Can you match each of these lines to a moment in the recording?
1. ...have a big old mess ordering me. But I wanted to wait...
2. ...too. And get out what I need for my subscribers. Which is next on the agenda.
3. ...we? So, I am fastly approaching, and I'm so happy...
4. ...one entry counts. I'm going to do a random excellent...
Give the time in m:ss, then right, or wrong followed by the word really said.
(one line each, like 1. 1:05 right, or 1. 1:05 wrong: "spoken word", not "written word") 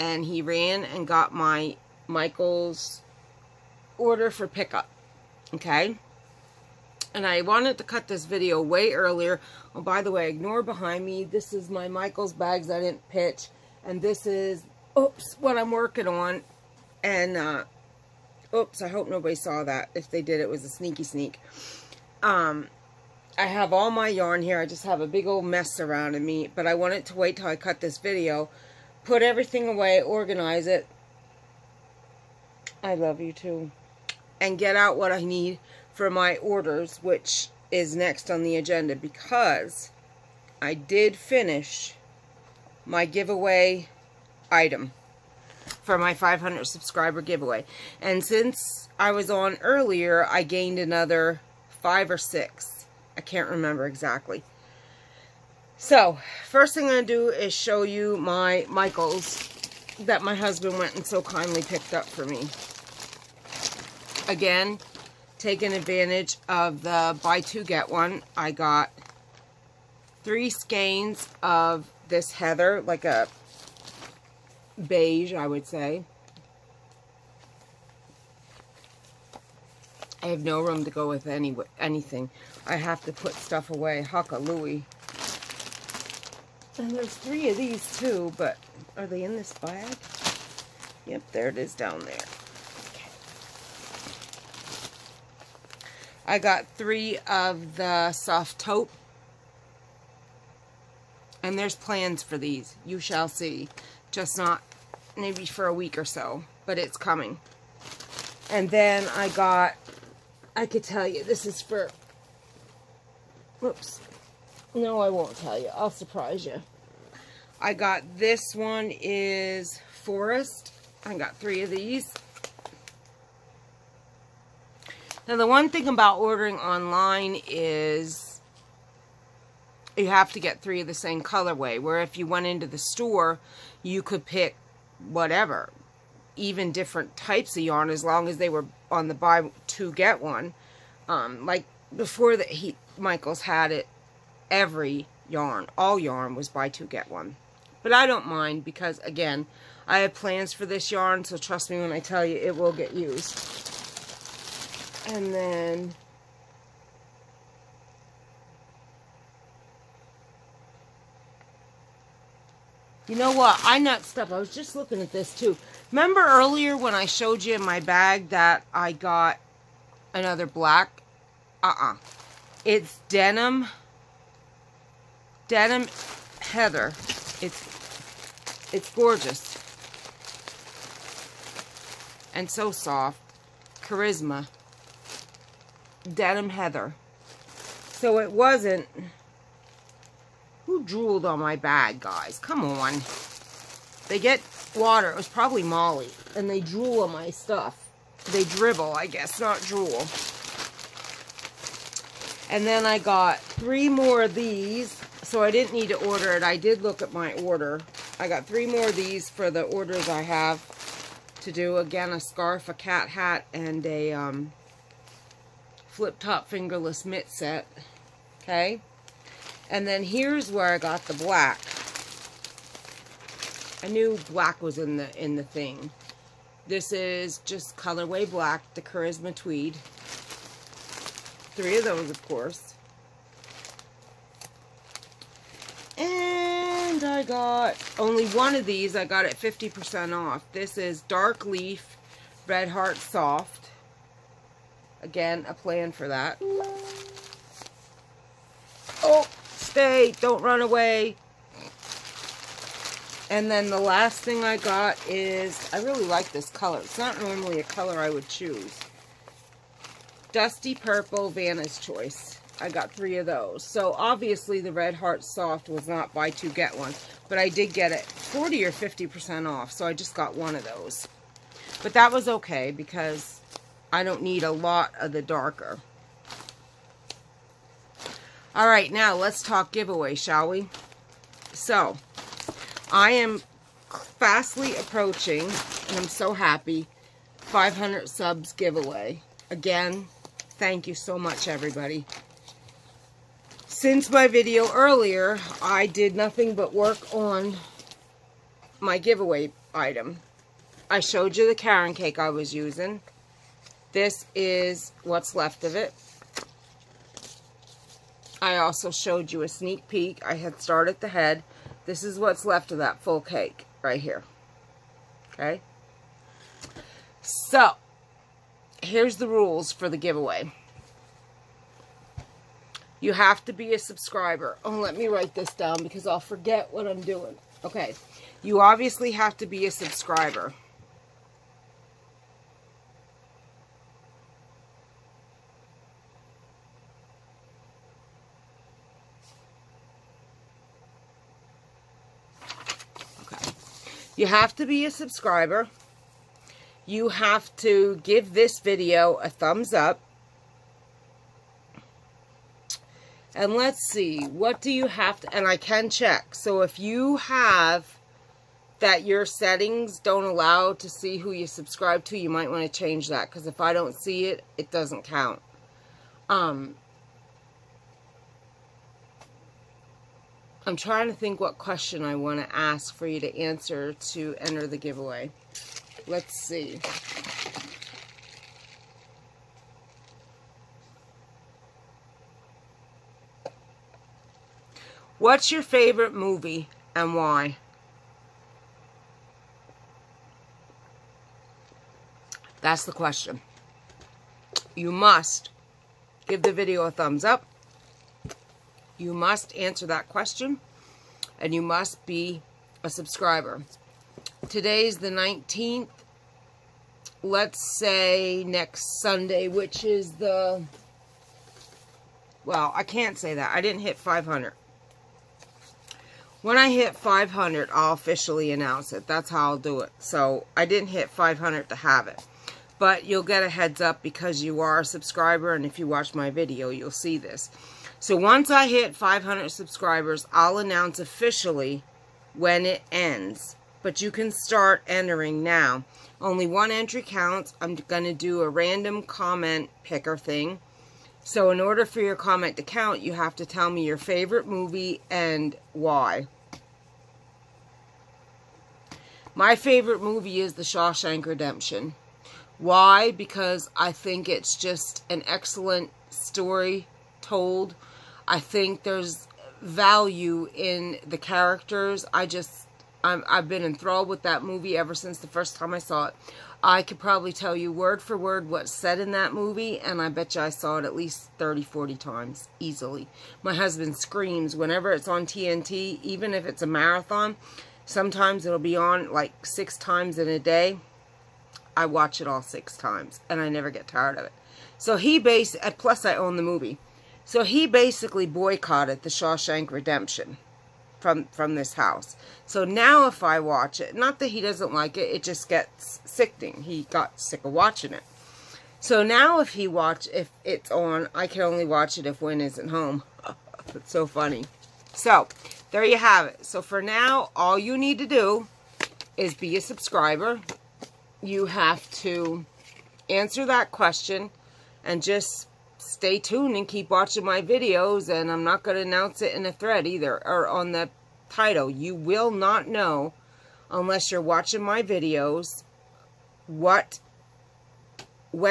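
1. 0:24 wrong: "surrounding", not "ordering"
2. 0:33 wrong: "orders", not "subscribers"
3. 4:40 right
4. 7:16 wrong: "comment", not "excellent".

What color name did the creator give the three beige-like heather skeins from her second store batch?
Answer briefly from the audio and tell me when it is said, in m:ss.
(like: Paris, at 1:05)
Soft taupe, at 1:38.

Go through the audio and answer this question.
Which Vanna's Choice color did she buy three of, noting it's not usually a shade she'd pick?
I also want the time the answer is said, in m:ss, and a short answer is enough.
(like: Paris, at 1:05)
Dusty Purple, at 4:20.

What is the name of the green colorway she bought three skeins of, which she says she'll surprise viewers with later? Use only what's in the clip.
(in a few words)
Forest.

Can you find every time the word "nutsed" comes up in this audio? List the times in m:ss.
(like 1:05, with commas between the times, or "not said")
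2:43.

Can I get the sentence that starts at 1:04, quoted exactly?
Again, taking advantage of the buy two get one.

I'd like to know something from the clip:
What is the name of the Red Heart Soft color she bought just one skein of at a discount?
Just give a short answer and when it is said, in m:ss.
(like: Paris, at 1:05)
Dark Leaf, at 4:01.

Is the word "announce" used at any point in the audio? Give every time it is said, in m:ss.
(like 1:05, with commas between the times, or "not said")
6:58, 7:10, 8:38.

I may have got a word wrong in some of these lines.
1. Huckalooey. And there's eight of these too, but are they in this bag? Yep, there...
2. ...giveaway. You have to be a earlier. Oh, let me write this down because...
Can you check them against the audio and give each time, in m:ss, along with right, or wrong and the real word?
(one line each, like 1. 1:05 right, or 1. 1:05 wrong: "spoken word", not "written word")
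1. 1:24 wrong: "three", not "eight"
2. 5:19 wrong: "subscriber", not "earlier".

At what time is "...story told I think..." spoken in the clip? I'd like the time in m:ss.
7:36.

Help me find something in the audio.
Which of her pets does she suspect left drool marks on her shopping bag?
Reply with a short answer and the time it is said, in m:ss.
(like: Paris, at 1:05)
Molly, at 3:15.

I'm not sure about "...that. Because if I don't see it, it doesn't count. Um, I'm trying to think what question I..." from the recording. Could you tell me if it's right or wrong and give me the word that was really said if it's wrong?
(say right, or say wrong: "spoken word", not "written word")
right.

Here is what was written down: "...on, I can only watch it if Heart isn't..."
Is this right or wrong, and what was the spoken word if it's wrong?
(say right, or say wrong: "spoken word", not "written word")
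wrong: "Win", not "Heart".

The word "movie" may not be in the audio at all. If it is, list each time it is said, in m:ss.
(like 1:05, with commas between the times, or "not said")
6:26, 7:24, 7:30, 7:44, 7:49, 8:06.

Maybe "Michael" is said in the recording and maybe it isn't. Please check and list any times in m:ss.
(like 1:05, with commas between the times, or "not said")
0:02, 0:11, 0:58, 2:22.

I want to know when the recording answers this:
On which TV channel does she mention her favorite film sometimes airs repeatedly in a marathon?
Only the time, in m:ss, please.
7:55.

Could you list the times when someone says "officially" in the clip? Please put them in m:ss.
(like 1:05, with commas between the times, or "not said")
6:57, 7:10.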